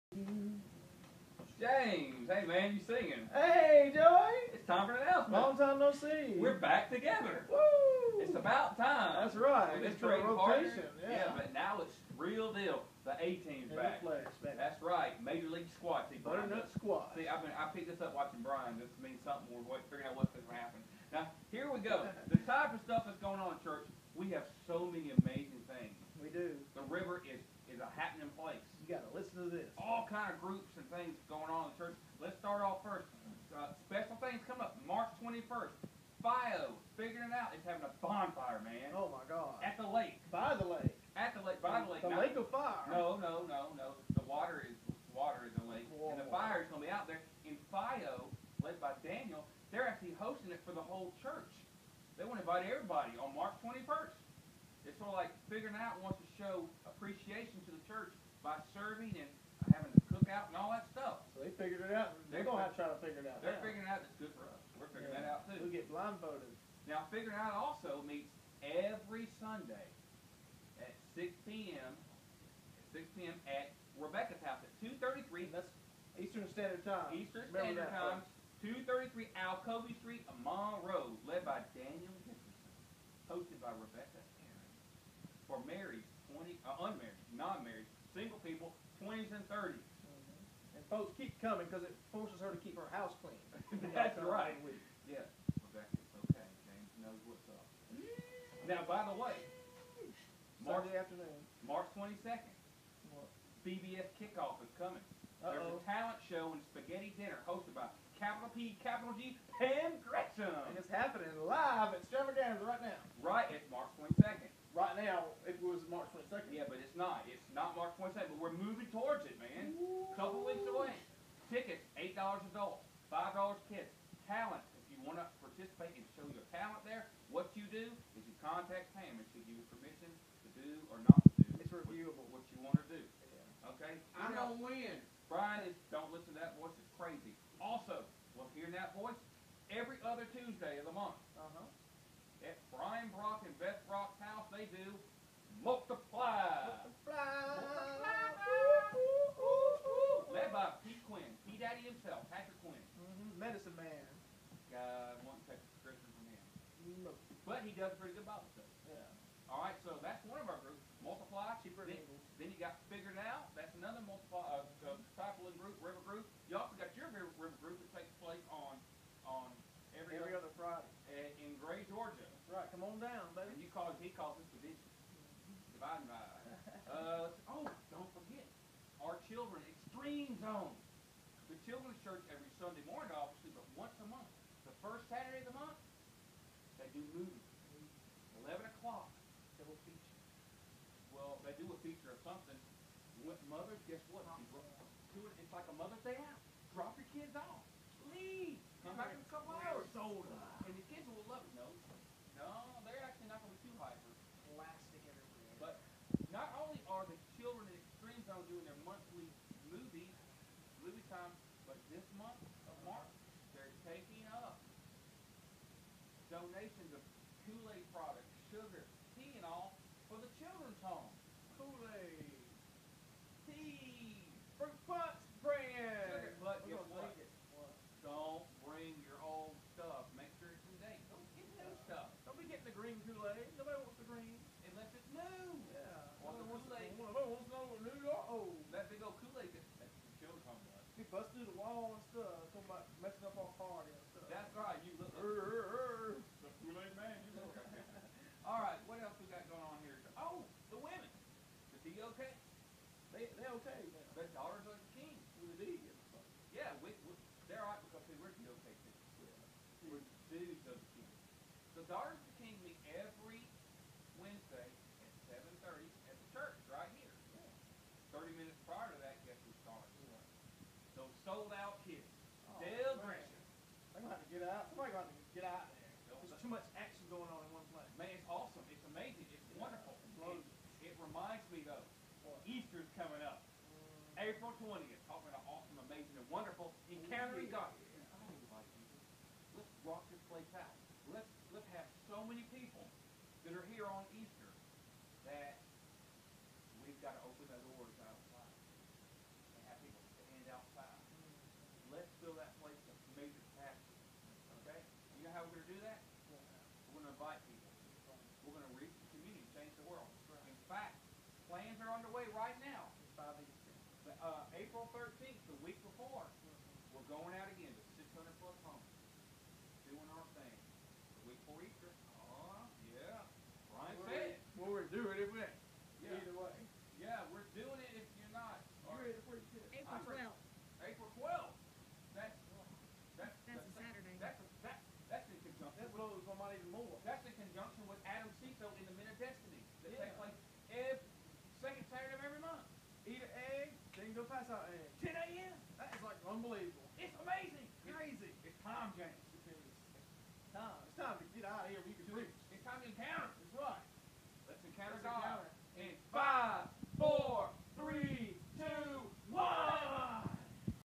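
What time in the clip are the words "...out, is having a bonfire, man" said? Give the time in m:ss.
0:37.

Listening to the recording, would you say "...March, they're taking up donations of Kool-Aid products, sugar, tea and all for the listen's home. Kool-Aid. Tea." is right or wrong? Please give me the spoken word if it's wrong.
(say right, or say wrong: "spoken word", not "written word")
wrong: "children", not "listen".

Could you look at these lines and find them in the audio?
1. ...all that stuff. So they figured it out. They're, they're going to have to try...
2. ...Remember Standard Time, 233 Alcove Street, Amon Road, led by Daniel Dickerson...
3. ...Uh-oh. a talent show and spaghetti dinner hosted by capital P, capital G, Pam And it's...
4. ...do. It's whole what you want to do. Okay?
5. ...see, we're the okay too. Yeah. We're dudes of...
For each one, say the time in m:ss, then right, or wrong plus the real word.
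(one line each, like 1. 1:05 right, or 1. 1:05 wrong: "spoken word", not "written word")
1. 1:00 right
2. 1:17 right
3. 1:45 right
4. 2:11 wrong: "reviewable", not "whole"
5. 4:18 right.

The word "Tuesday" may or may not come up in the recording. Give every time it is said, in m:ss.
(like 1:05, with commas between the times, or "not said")
2:20.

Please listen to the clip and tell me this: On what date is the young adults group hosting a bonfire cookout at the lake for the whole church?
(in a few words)
March 21st.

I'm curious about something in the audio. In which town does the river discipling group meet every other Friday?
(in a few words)
Gray, Georgia.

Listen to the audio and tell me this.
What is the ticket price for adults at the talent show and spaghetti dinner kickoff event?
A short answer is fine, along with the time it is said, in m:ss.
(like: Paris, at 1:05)
$8, at 2:01.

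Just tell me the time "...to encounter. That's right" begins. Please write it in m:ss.
5:52.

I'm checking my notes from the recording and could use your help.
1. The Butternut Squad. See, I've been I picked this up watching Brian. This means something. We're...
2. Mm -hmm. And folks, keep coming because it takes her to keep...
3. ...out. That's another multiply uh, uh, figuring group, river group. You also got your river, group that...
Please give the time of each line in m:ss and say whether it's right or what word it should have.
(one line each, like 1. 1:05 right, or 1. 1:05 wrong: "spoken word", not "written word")
1. 0:16 right
2. 1:29 wrong: "forces", not "takes"
3. 2:43 wrong: "discipling", not "figuring".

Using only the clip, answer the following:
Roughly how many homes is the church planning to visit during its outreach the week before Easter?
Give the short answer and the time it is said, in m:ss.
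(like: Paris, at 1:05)
600 plus, at 5:17.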